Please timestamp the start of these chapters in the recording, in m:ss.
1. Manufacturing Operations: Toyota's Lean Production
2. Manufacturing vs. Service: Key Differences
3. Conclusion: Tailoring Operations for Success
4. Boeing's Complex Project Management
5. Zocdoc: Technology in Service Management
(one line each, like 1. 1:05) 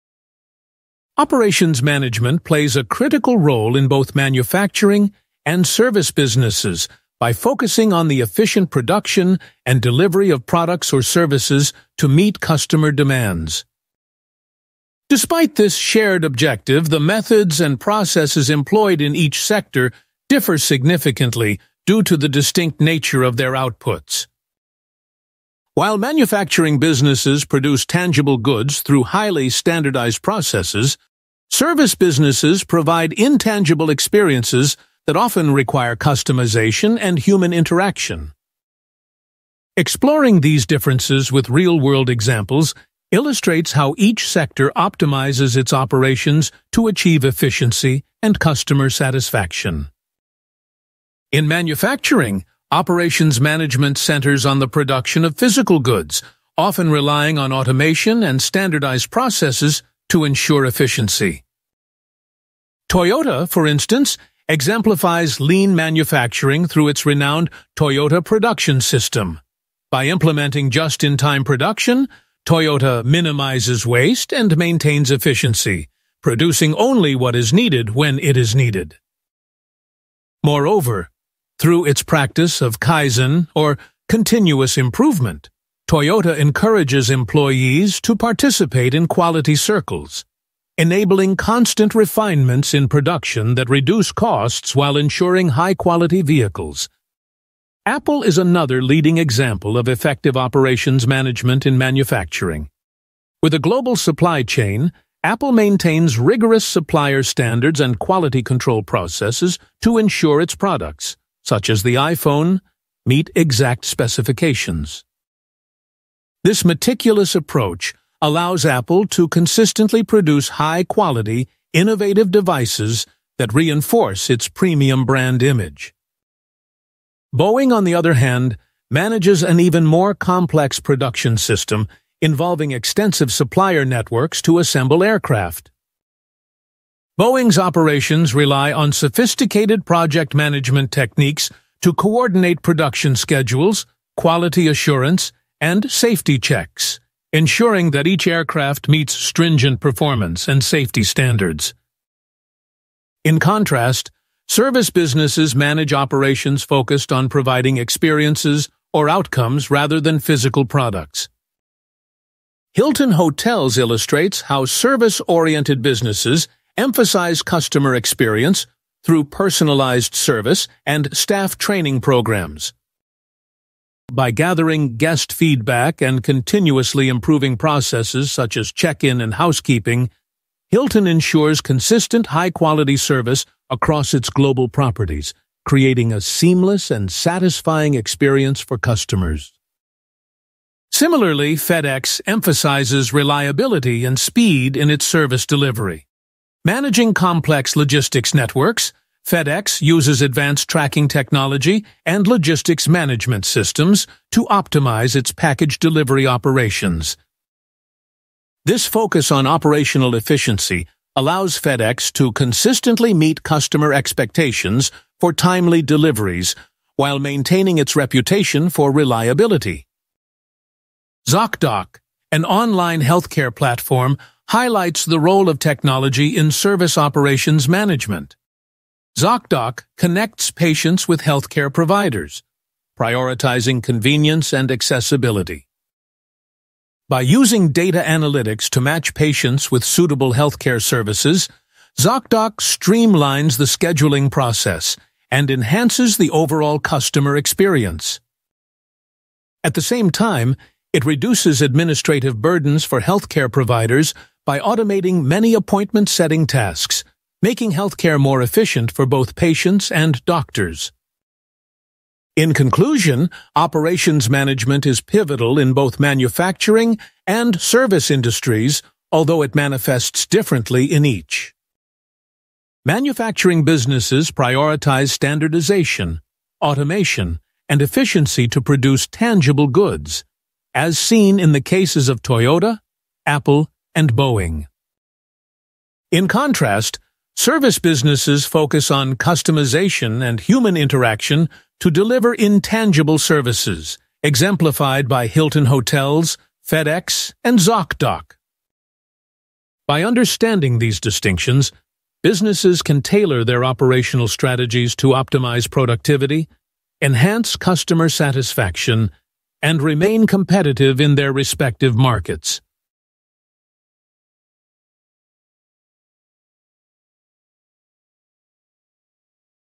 1. 0:52
2. 0:15
3. 4:45
4. 2:15
5. 4:05.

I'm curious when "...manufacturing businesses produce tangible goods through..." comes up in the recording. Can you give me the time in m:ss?
0:25.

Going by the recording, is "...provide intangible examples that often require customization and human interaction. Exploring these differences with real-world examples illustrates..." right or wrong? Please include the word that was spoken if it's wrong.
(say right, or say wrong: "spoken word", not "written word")
wrong: "experiences", not "examples".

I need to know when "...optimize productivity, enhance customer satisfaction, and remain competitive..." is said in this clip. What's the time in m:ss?
5:05.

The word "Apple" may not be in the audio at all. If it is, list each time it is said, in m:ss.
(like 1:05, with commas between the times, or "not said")
1:37, 1:45, 1:58, 4:43.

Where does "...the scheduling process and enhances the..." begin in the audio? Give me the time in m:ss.
4:03.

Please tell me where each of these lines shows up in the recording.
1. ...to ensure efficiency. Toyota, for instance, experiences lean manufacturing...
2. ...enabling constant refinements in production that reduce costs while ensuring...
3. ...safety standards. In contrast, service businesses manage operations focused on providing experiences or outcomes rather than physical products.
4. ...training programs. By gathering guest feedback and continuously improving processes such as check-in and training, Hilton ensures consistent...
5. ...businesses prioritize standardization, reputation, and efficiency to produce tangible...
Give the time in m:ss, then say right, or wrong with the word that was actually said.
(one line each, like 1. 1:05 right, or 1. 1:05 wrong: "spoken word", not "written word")
1. 1:00 wrong: "exemplifies", not "experiences"
2. 1:30 right
3. 2:30 right
4. 2:51 wrong: "housekeeping", not "training"
5. 4:33 wrong: "automation", not "reputation".